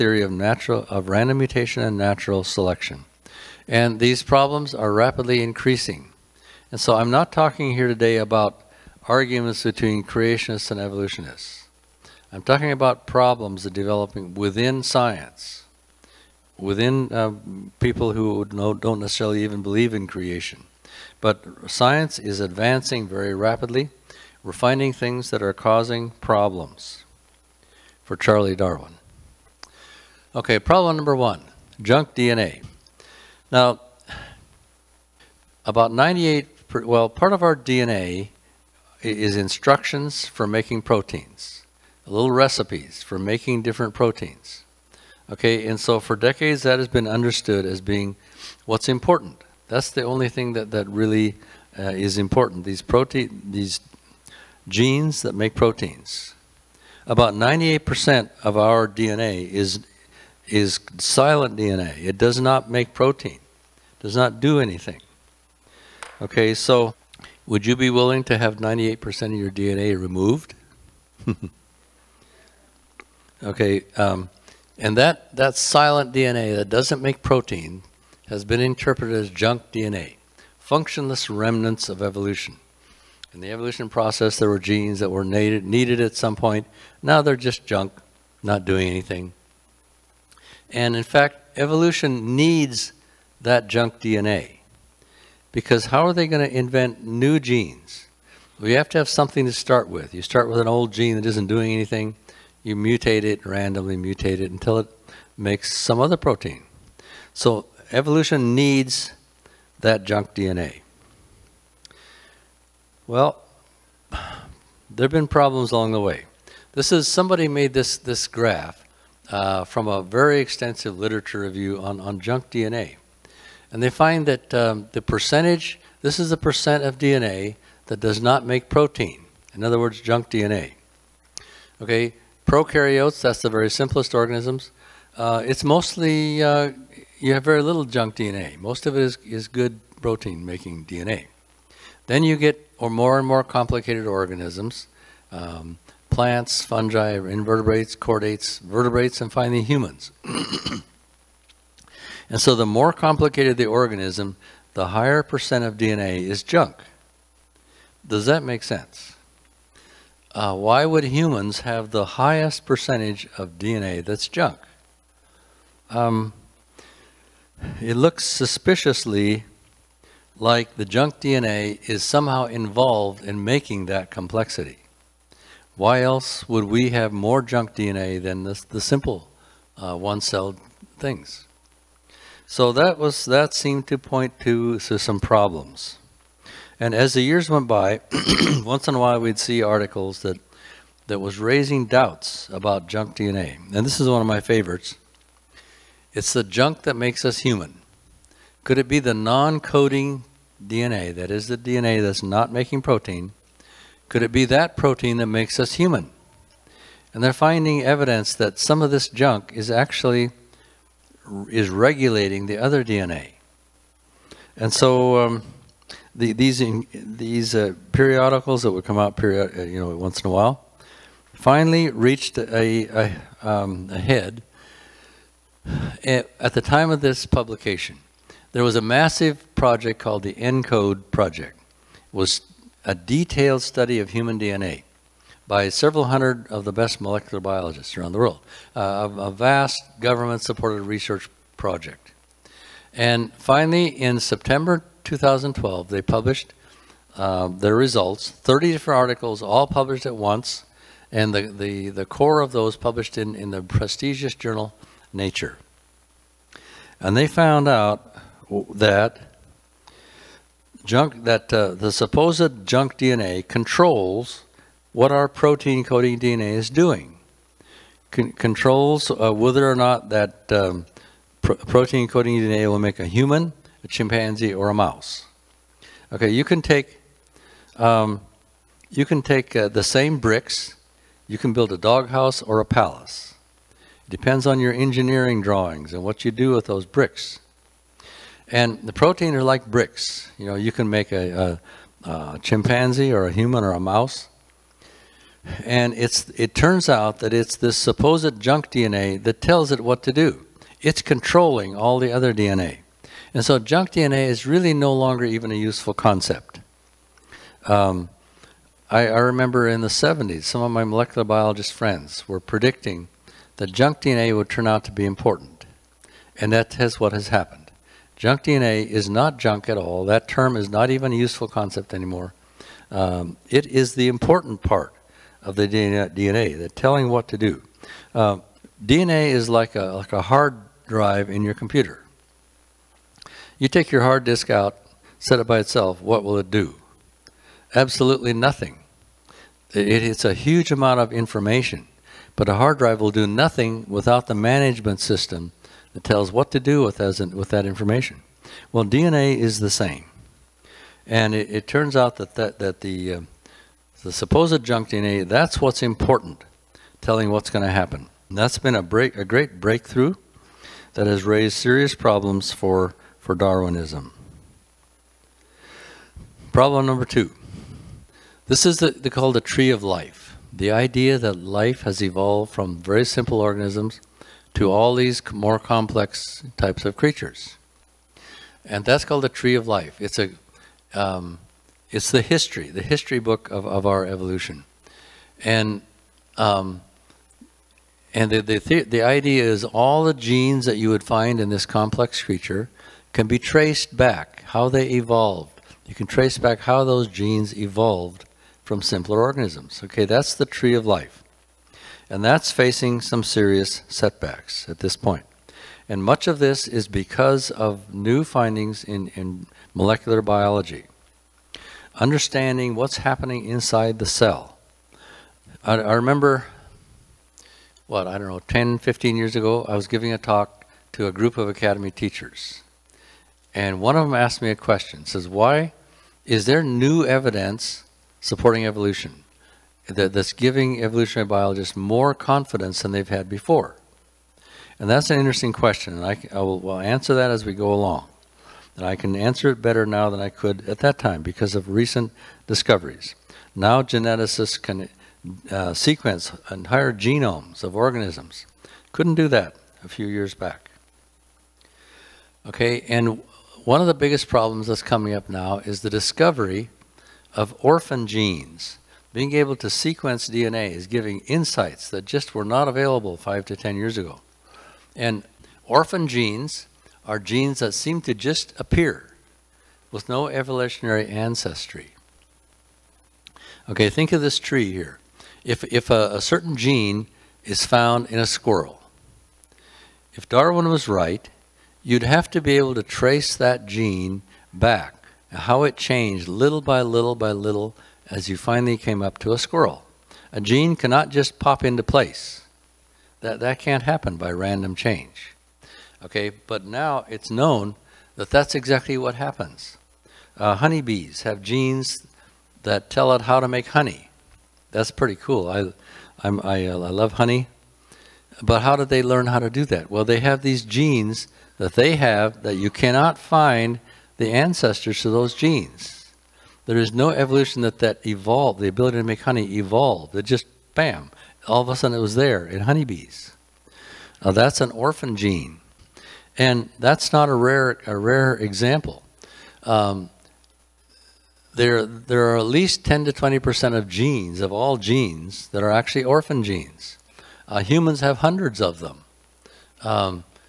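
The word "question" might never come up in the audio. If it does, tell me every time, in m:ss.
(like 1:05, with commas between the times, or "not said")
7:04, 7:15.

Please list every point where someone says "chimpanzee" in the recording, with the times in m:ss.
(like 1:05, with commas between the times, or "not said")
4:33, 4:52.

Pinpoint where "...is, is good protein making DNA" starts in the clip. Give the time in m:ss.
2:19.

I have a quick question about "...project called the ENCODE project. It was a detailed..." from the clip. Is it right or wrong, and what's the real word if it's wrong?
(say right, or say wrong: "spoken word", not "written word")
right.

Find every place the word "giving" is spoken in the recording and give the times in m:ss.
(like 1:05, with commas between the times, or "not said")
6:59, 7:10, 7:40.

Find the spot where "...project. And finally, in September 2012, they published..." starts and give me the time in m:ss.
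4:01.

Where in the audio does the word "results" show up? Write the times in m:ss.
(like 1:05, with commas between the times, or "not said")
4:07.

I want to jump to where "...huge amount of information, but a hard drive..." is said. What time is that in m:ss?
5:40.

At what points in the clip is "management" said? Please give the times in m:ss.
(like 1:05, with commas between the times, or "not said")
5:44.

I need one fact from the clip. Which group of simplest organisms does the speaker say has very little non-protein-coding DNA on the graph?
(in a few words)
Prokaryotes.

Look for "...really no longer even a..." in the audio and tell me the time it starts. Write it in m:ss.
5:04.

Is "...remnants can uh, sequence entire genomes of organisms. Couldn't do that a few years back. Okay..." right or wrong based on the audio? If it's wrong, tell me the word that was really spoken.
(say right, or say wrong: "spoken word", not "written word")
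wrong: "geneticists", not "remnants".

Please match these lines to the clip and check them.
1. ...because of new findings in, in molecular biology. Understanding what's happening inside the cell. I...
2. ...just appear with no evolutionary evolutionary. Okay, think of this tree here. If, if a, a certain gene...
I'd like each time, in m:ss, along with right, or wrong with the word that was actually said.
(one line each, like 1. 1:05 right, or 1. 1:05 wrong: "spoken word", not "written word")
1. 6:46 right
2. 7:48 wrong: "ancestry", not "evolutionary".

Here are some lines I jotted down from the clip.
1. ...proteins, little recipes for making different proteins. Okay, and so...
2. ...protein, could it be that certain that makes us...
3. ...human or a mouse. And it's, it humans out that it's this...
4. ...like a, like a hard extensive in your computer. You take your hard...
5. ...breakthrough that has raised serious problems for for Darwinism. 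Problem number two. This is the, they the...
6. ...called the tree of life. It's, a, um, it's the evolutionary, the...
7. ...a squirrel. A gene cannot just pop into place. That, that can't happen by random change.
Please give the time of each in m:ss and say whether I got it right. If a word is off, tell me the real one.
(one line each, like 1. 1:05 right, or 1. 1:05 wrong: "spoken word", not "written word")
1. 0:40 right
2. 3:22 wrong: "protein", not "certain"
3. 4:53 wrong: "turns", not "humans"
4. 5:29 wrong: "drive", not "extensive"
5. 5:59 right
6. 6:19 wrong: "history", not "evolutionary"
7. 8:09 right.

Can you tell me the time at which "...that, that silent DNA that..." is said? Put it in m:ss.
1:14.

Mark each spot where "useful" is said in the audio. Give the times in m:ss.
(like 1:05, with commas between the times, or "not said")
5:05, 5:21.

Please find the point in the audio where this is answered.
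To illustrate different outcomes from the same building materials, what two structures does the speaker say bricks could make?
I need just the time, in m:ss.
4:41.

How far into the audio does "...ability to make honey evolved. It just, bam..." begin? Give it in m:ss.
8:38.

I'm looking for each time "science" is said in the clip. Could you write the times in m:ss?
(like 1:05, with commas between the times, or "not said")
0:14, 0:21.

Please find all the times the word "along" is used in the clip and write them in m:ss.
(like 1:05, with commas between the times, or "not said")
1:55, 7:17.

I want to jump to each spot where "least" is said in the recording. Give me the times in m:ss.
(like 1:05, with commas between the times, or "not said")
8:52.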